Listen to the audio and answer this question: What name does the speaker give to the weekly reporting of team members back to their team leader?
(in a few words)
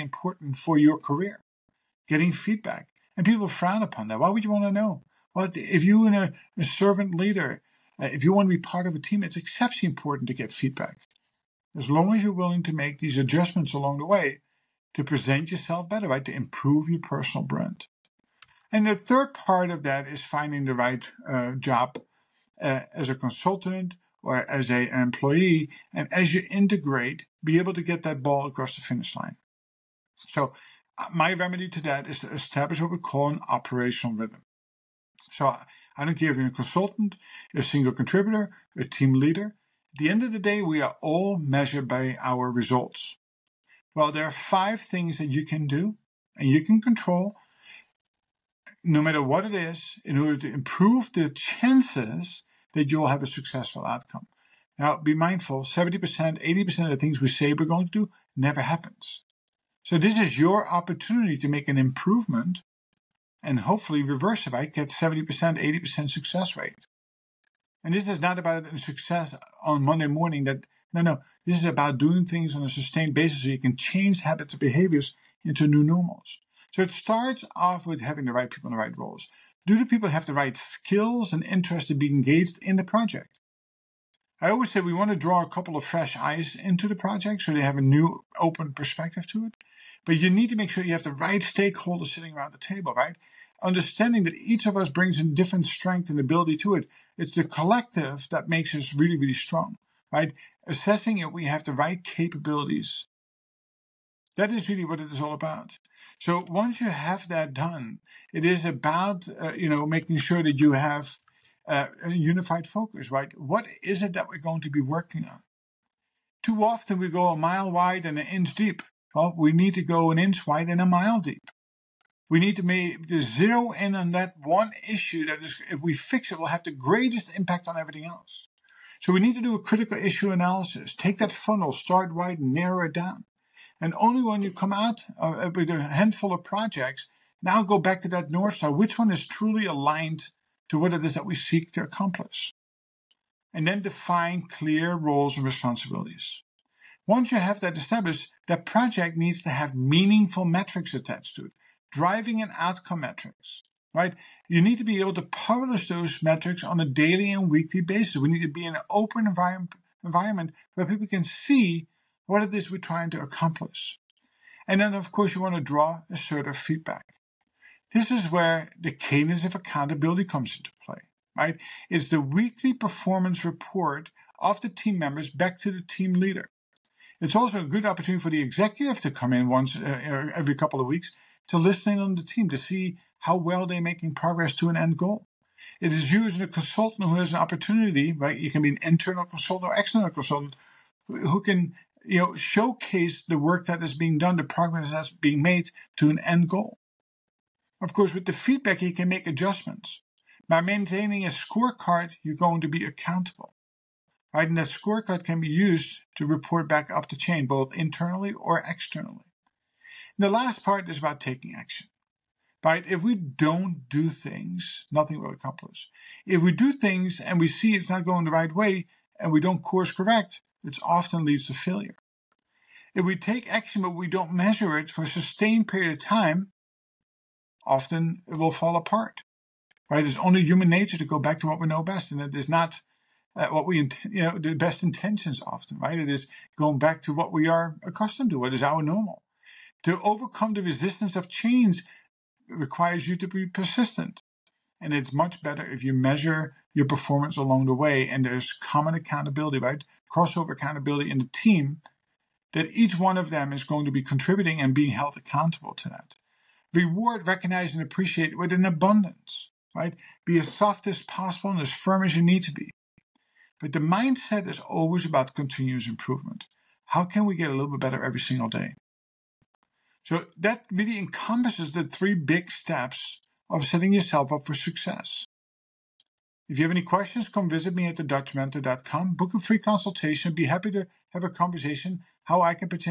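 cadence of accountability.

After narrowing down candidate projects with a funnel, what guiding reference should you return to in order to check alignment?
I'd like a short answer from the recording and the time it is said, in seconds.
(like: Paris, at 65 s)
North Star, at 138 s.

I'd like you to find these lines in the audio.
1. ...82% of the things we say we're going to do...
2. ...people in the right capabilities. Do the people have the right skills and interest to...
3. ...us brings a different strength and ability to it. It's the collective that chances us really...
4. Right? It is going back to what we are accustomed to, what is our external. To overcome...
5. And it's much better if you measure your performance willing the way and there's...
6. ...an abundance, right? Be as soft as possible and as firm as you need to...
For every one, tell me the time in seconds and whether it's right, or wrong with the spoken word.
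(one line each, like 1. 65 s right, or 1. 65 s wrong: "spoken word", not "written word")
1. 56 s wrong: "80", not "82"
2. 78 s wrong: "roles", not "capabilities"
3. 94 s wrong: "makes", not "chances"
4. 235 s wrong: "normal", not "external"
5. 244 s wrong: "along", not "willing"
6. 258 s right.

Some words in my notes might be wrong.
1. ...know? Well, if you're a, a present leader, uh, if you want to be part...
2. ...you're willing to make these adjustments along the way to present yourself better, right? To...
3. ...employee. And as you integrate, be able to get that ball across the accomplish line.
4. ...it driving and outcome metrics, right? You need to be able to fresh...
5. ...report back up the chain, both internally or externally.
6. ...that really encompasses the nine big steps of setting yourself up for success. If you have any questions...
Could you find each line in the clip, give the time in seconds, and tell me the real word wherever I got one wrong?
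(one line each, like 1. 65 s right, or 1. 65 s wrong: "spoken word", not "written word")
1. 4 s wrong: "servant", not "present"
2. 12 s right
3. 24 s wrong: "finish", not "accomplish"
4. 151 s wrong: "publish", not "fresh"
5. 206 s right
6. 270 s wrong: "three", not "nine".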